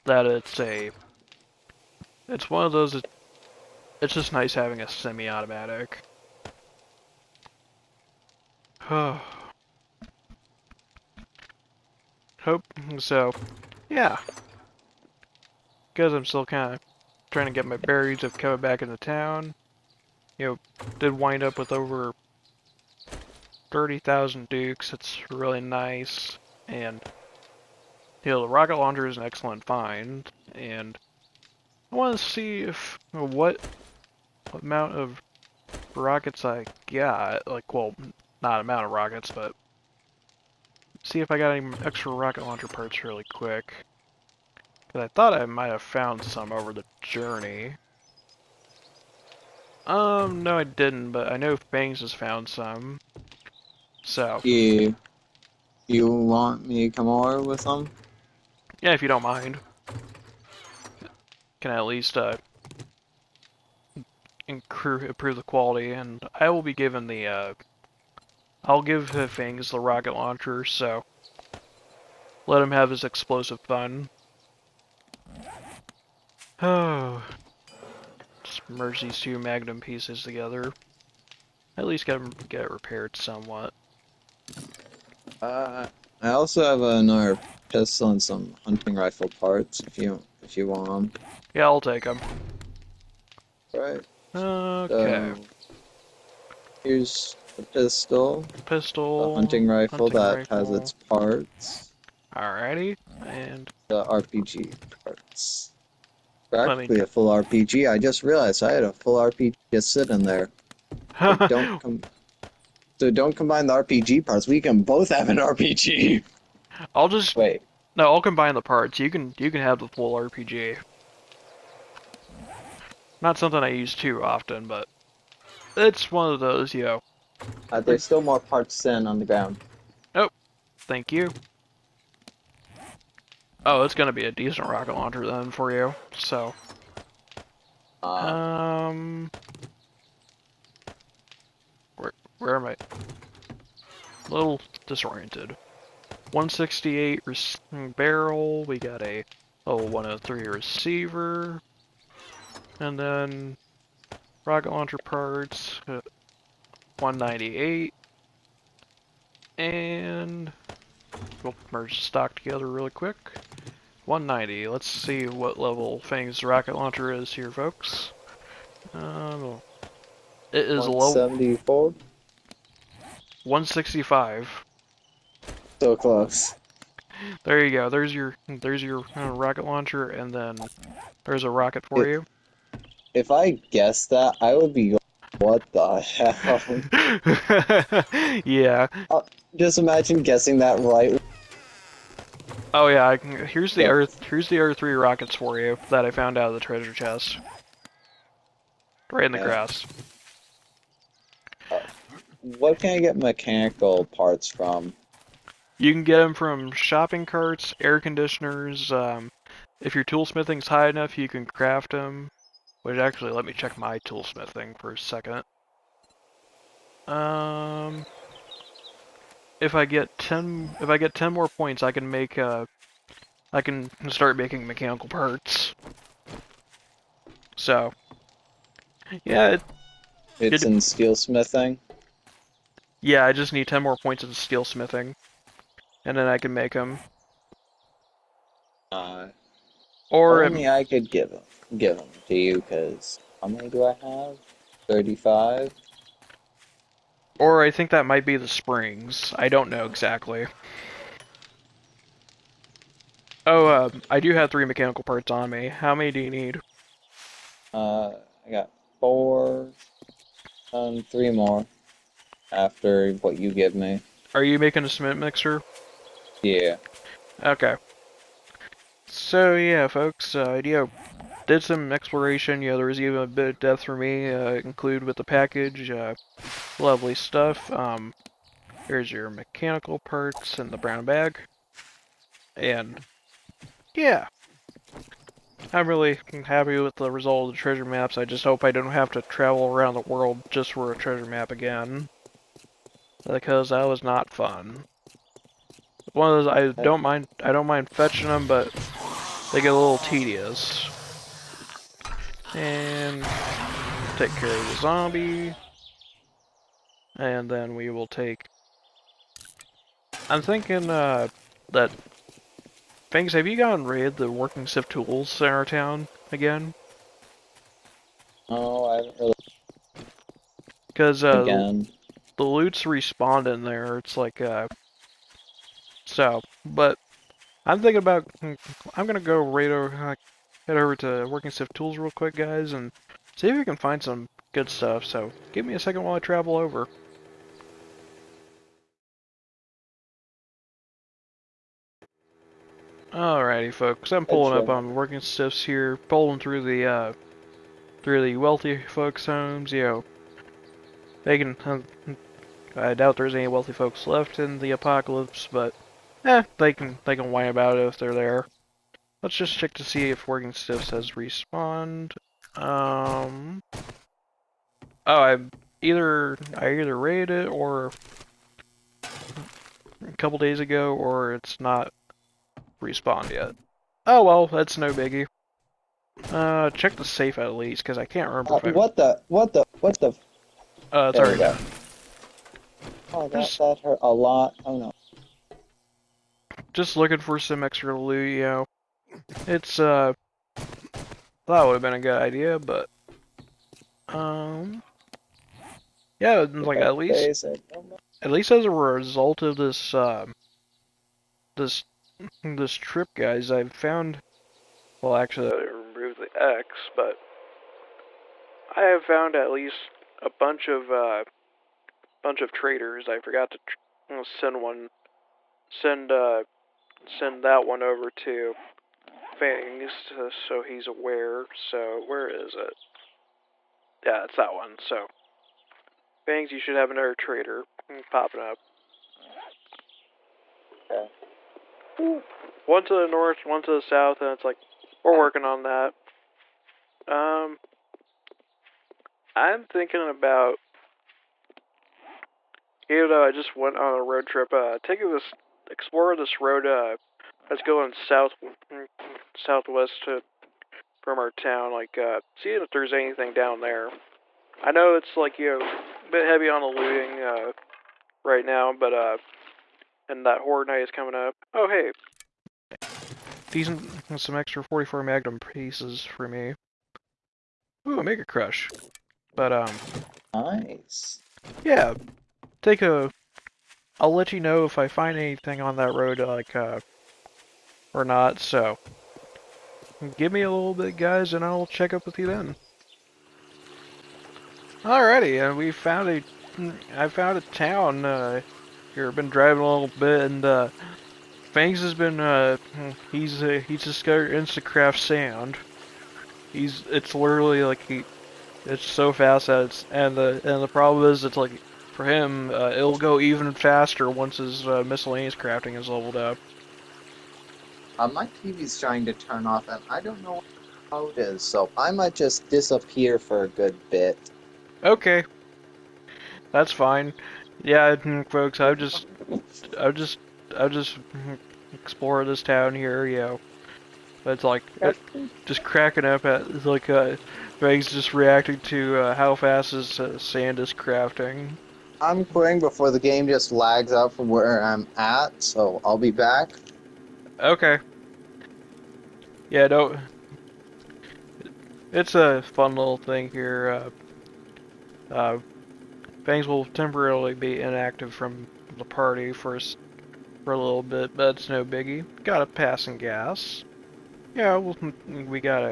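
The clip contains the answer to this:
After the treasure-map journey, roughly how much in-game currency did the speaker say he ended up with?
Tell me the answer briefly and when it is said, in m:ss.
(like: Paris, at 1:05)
over 30,000 dukes, at 0:21.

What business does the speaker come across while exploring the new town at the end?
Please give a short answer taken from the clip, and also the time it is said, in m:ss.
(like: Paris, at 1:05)
Pass-n-Gas, at 9:12.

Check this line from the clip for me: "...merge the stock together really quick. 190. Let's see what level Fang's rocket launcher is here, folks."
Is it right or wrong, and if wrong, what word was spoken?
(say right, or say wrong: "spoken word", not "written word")
right.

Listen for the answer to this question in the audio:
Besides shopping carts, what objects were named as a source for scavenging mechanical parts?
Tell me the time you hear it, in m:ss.
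3:27.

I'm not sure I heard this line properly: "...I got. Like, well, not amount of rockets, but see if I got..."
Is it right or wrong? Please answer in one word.
right.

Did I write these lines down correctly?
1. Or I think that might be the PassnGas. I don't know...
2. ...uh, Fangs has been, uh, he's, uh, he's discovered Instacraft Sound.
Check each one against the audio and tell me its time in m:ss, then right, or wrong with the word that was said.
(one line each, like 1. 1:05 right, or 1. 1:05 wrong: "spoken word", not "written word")
1. 4:07 wrong: "Springs", not "PassnGas"
2. 8:10 right.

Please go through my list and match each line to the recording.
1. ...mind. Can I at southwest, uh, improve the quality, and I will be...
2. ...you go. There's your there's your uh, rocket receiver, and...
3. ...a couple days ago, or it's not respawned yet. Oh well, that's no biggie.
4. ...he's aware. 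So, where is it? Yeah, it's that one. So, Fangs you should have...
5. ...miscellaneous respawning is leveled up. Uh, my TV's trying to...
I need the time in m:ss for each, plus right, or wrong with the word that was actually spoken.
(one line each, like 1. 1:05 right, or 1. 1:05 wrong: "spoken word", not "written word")
1. 0:59 wrong: "least", not "southwest"
2. 2:57 wrong: "launcher", not "receiver"
3. 6:09 right
4. 7:00 right
5. 8:24 wrong: "crafting", not "respawning".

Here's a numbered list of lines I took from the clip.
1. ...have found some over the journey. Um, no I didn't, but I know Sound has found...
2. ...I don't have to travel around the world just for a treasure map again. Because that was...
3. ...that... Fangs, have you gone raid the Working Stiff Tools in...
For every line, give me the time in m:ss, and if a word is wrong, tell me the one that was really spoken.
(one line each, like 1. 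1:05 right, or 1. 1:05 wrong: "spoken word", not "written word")
1. 0:45 wrong: "Fangs", not "Sound"
2. 4:48 right
3. 5:11 right.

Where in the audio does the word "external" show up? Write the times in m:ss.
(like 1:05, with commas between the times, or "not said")
not said.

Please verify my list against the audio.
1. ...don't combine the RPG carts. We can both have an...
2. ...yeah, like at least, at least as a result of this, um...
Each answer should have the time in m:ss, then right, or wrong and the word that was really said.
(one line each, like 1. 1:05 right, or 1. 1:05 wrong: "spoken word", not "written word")
1. 1:53 wrong: "parts", not "carts"
2. 6:36 right.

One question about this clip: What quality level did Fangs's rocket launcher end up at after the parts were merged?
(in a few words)
165.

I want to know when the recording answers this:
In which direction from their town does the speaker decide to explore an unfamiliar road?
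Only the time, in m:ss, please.
7:27.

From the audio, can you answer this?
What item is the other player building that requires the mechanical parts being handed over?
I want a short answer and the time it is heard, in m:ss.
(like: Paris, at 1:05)
cement mixer, at 4:24.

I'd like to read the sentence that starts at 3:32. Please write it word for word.
Which actually, let me check my toolsmithing for a second.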